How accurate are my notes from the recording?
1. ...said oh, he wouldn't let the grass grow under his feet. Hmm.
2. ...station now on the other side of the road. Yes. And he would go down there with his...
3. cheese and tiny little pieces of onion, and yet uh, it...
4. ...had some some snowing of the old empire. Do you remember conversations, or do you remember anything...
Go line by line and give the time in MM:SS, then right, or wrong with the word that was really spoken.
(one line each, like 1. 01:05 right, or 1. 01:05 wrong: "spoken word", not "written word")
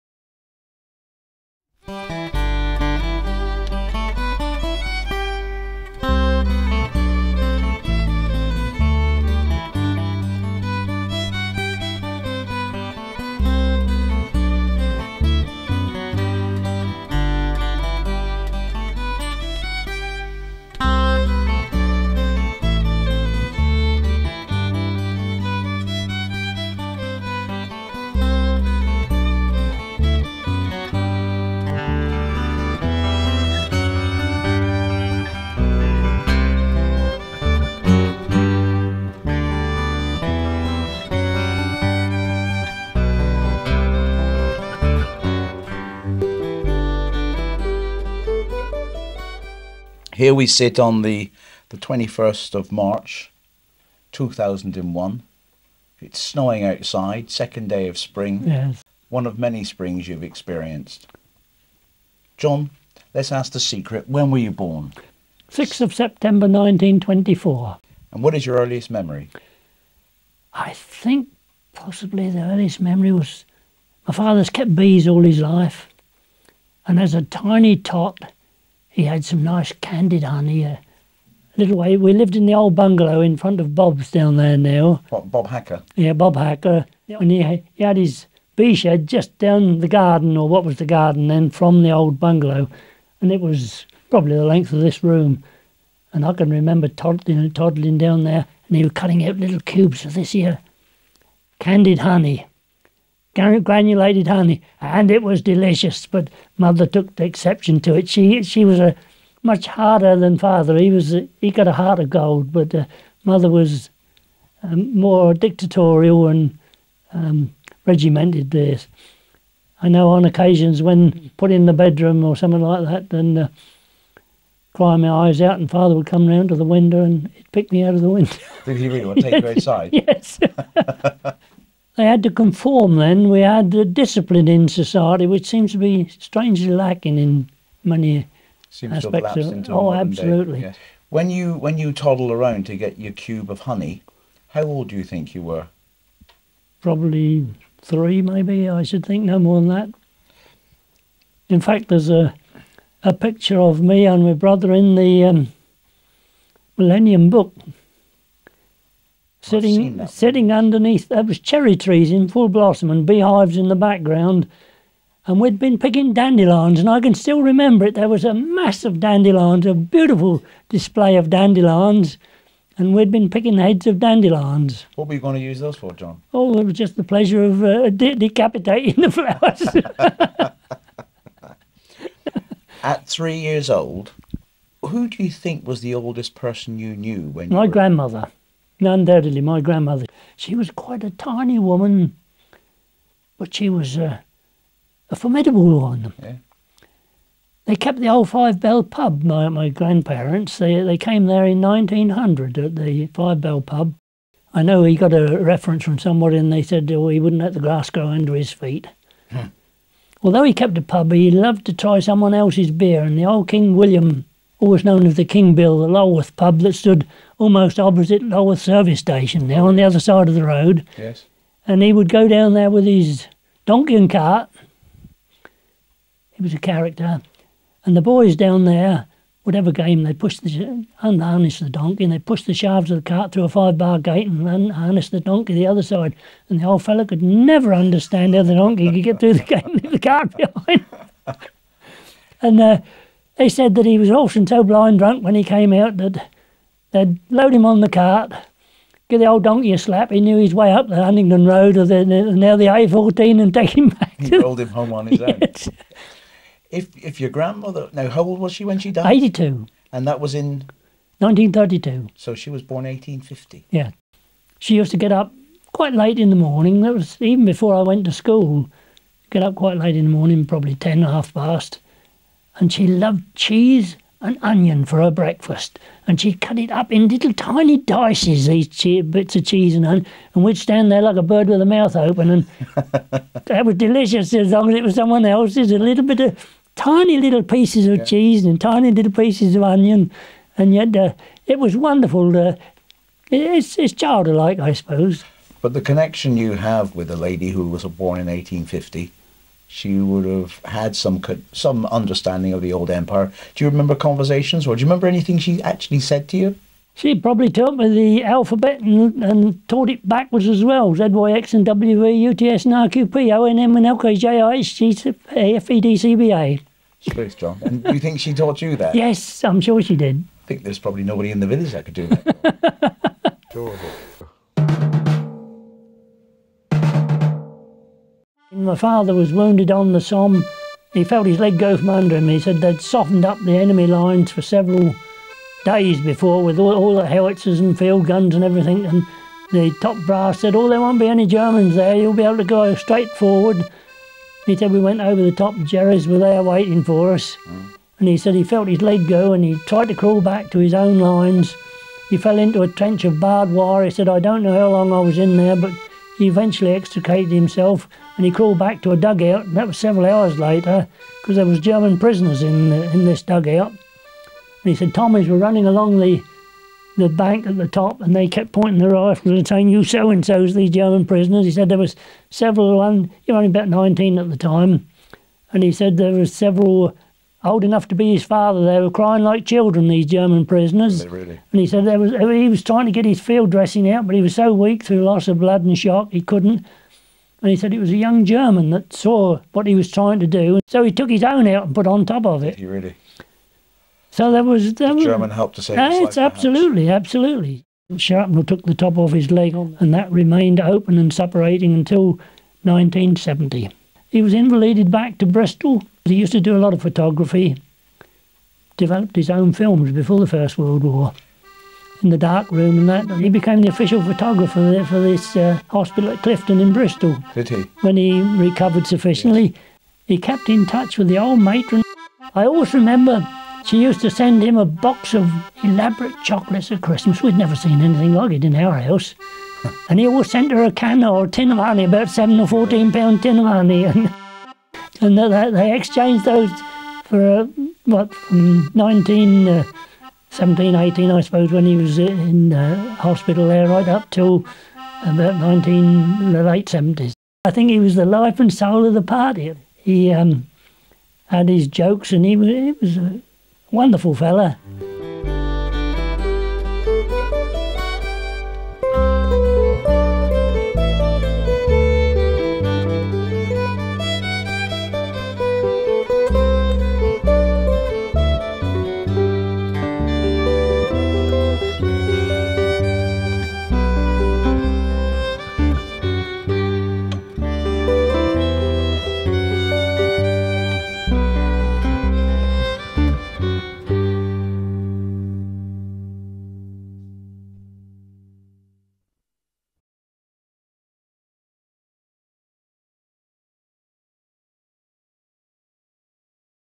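1. 03:26 right
2. 03:38 right
3. 04:48 right
4. 05:00 wrong: "understanding", not "snowing".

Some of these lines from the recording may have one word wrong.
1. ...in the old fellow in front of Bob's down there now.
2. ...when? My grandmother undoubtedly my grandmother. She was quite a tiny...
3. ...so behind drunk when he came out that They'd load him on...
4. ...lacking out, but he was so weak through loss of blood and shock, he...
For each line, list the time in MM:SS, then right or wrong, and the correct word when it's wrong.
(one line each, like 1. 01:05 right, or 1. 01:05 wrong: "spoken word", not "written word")
1. 01:22 wrong: "bungalow", not "fellow"
2. 03:07 right
3. 04:04 wrong: "blind", not "behind"
4. 06:23 wrong: "dressing", not "lacking".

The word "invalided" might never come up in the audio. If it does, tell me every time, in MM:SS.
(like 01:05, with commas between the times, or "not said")
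06:44.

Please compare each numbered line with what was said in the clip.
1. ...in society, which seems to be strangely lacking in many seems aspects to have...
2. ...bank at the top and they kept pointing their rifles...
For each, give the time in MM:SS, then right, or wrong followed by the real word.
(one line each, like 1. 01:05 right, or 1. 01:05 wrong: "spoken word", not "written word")
1. 02:14 right
2. 06:07 right.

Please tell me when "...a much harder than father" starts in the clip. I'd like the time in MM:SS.
01:48.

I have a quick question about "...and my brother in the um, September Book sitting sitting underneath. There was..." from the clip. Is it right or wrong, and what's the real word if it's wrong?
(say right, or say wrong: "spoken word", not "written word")
wrong: "Millennium", not "September".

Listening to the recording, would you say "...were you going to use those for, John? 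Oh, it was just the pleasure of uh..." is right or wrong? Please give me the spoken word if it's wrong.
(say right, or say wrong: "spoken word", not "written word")
right.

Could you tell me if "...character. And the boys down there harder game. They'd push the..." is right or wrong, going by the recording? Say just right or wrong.
wrong.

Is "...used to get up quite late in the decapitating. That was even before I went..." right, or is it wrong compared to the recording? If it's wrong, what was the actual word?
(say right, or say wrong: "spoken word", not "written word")
wrong: "morning", not "decapitating".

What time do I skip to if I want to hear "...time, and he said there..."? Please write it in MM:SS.
06:14.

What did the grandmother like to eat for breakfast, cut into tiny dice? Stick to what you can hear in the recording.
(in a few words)
Cheese and onion.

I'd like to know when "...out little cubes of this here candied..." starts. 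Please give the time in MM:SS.
01:39.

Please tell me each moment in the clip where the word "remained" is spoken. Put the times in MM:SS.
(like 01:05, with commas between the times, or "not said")
06:40.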